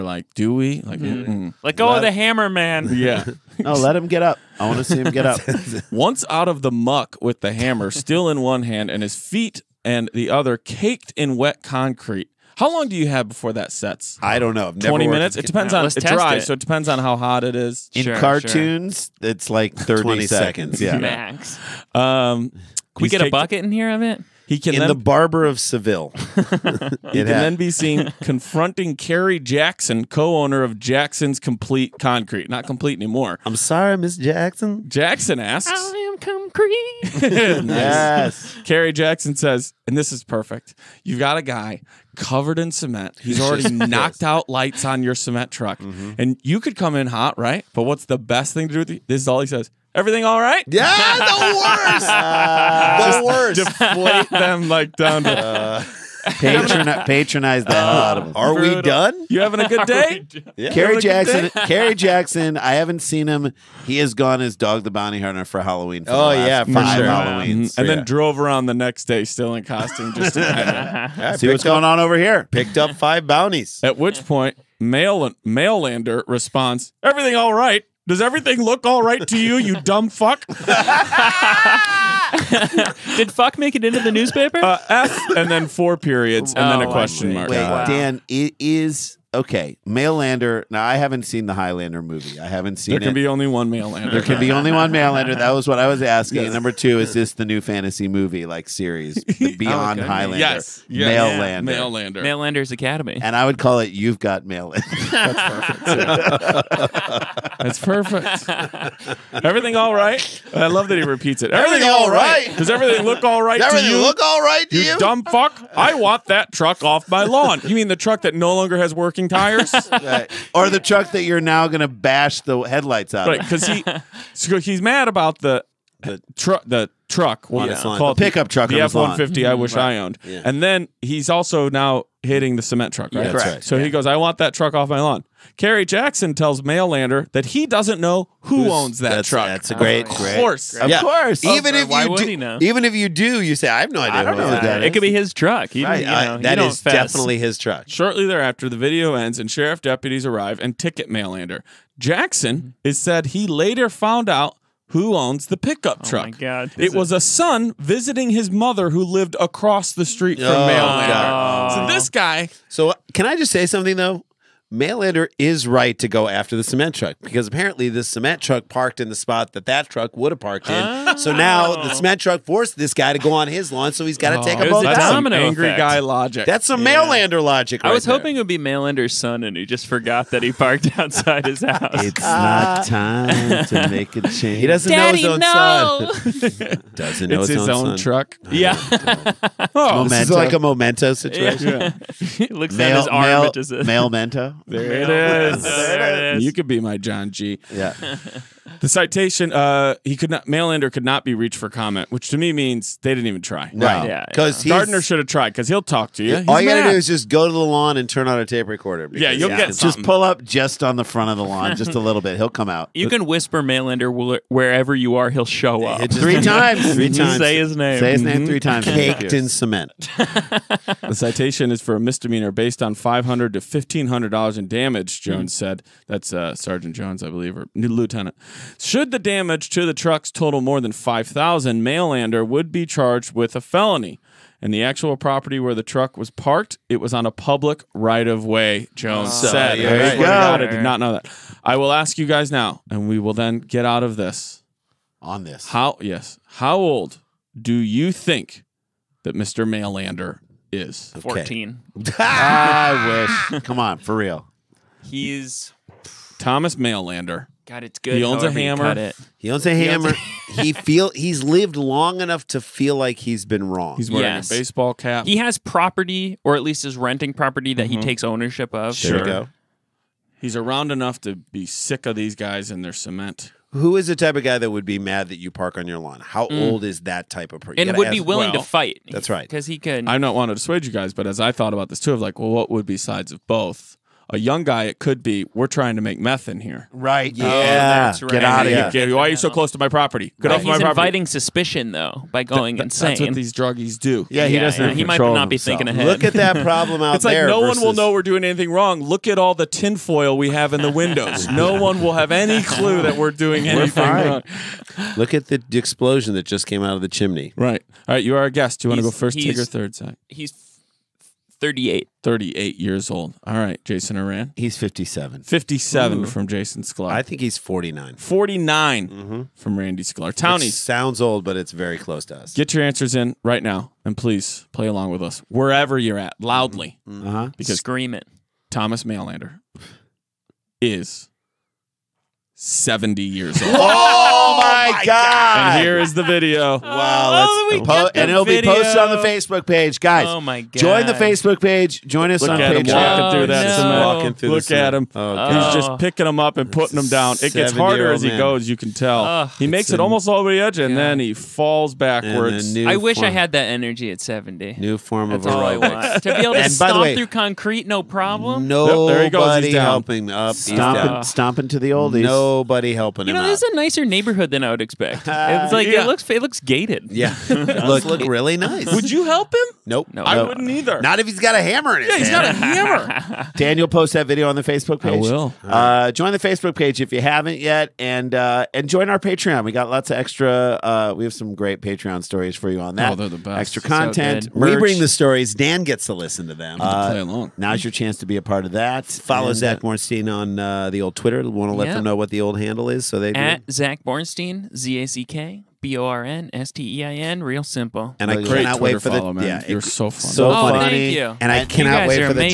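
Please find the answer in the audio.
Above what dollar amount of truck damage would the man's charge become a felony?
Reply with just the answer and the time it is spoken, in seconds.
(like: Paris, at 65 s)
5,000, at 230 s.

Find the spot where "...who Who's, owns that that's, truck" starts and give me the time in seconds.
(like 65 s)
138 s.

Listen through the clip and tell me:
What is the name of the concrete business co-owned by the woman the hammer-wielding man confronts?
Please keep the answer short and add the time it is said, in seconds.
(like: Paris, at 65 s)
Jackson's Complete Concrete, at 30 s.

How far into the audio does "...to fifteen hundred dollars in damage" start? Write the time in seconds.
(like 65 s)
223 s.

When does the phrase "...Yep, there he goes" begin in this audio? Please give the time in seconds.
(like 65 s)
359 s.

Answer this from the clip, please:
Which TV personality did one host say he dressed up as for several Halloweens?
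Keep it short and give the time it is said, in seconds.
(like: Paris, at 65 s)
Dog the Bounty Hunter, at 64 s.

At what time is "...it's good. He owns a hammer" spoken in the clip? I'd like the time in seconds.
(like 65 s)
257 s.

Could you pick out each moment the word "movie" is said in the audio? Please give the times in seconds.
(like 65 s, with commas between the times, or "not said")
92 s, 98 s.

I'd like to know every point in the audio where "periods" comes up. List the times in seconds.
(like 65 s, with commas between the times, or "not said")
85 s.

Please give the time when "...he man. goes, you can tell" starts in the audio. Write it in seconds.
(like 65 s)
348 s.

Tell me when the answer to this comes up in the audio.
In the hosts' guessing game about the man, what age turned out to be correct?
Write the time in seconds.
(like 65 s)
332 s.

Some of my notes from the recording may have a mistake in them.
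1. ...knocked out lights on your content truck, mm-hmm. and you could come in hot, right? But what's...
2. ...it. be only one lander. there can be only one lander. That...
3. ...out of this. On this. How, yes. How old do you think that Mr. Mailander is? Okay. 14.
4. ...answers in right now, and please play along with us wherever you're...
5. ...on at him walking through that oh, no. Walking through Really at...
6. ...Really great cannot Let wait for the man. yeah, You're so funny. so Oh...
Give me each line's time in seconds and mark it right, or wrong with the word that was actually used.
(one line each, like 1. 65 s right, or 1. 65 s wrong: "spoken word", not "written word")
1. 43 s wrong: "cement", not "content"
2. 93 s right
3. 243 s right
4. 322 s right
5. 342 s wrong: "Look", not "Really"
6. 398 s wrong: "Twitter", not "Let".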